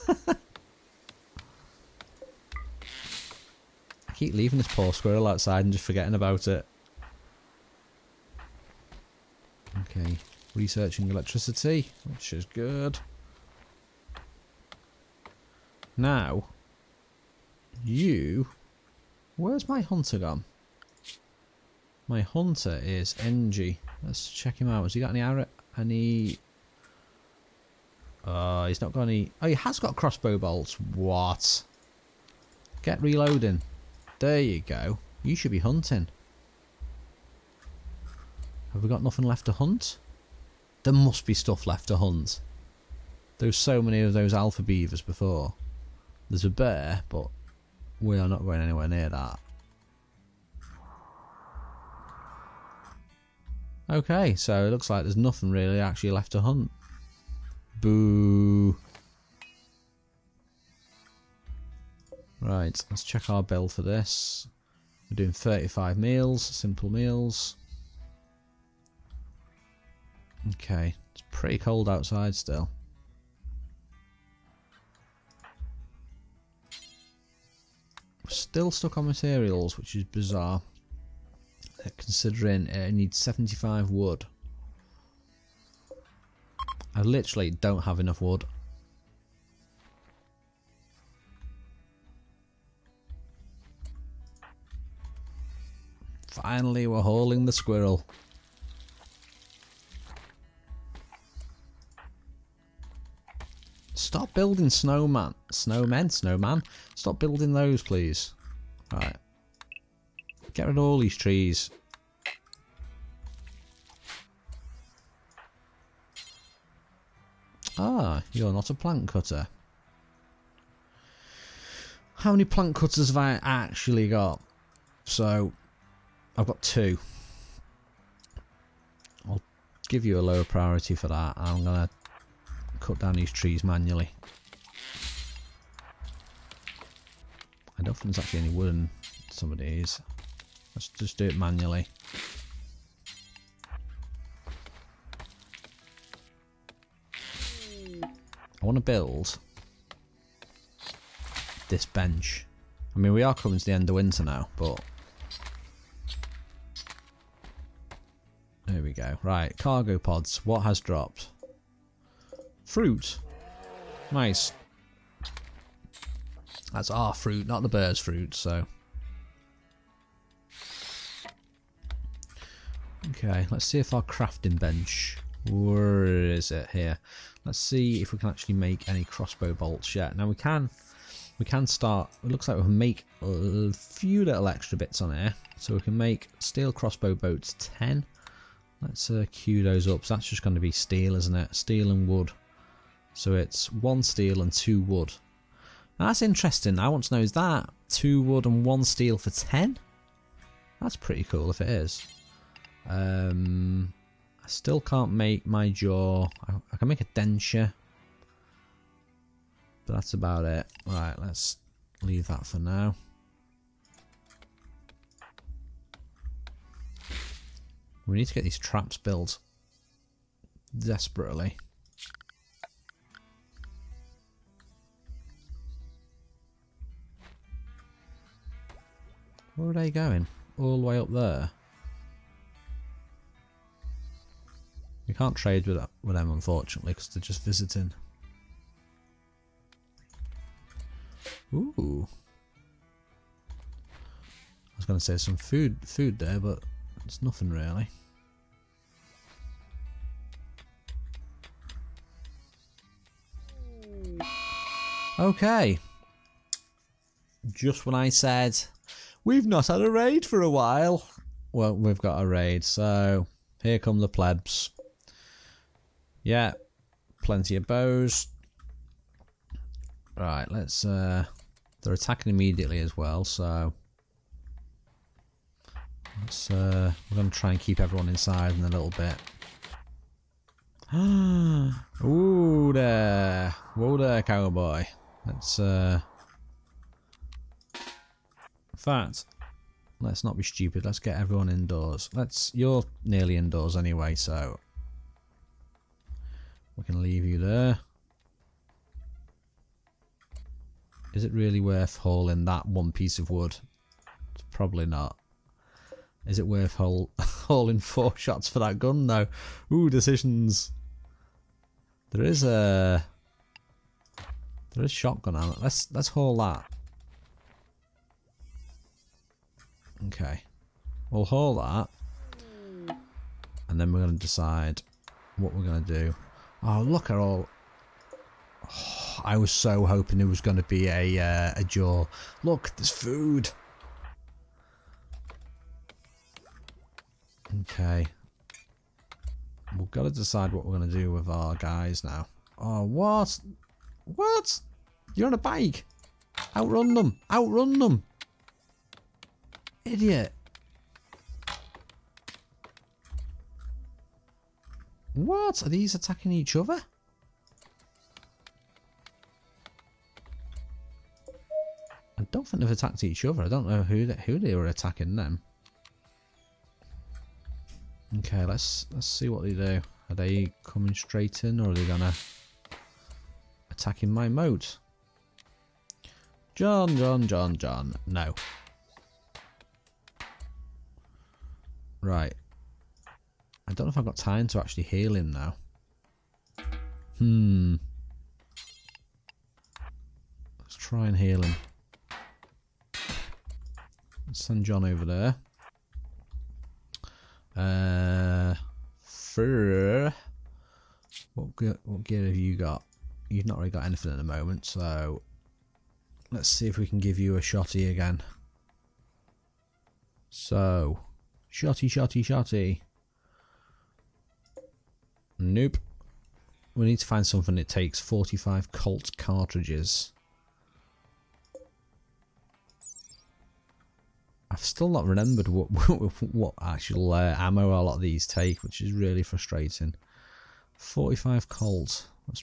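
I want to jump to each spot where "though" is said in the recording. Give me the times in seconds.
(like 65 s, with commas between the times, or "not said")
309 s.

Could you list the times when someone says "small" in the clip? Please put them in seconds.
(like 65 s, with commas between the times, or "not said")
not said.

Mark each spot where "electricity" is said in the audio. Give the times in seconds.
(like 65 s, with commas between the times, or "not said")
11 s.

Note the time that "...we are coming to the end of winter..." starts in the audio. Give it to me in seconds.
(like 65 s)
153 s.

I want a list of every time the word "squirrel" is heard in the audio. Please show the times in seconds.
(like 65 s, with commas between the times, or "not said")
4 s, 97 s.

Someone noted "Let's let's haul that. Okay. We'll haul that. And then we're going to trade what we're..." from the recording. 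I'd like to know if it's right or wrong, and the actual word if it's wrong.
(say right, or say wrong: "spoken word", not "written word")
wrong: "decide", not "trade".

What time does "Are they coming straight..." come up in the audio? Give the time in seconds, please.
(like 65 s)
370 s.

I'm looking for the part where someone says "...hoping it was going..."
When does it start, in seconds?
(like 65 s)
329 s.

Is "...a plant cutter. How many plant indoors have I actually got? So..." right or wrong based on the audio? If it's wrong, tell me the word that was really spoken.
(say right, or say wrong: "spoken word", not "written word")
wrong: "cutters", not "indoors".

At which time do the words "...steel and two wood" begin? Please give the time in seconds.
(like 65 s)
194 s.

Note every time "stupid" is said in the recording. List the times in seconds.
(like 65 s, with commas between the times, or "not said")
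290 s.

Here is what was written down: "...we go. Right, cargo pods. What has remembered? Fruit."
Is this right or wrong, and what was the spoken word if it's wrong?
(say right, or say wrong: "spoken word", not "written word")
wrong: "dropped", not "remembered".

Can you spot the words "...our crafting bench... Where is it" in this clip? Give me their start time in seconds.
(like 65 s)
173 s.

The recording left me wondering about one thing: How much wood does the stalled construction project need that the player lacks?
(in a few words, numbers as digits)
75.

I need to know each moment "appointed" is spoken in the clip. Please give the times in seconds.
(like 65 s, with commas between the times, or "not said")
not said.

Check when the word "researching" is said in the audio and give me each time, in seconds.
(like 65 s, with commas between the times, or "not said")
10 s.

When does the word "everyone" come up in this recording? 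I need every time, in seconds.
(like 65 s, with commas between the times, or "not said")
277 s, 291 s.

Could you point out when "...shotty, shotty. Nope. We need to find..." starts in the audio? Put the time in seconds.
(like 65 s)
411 s.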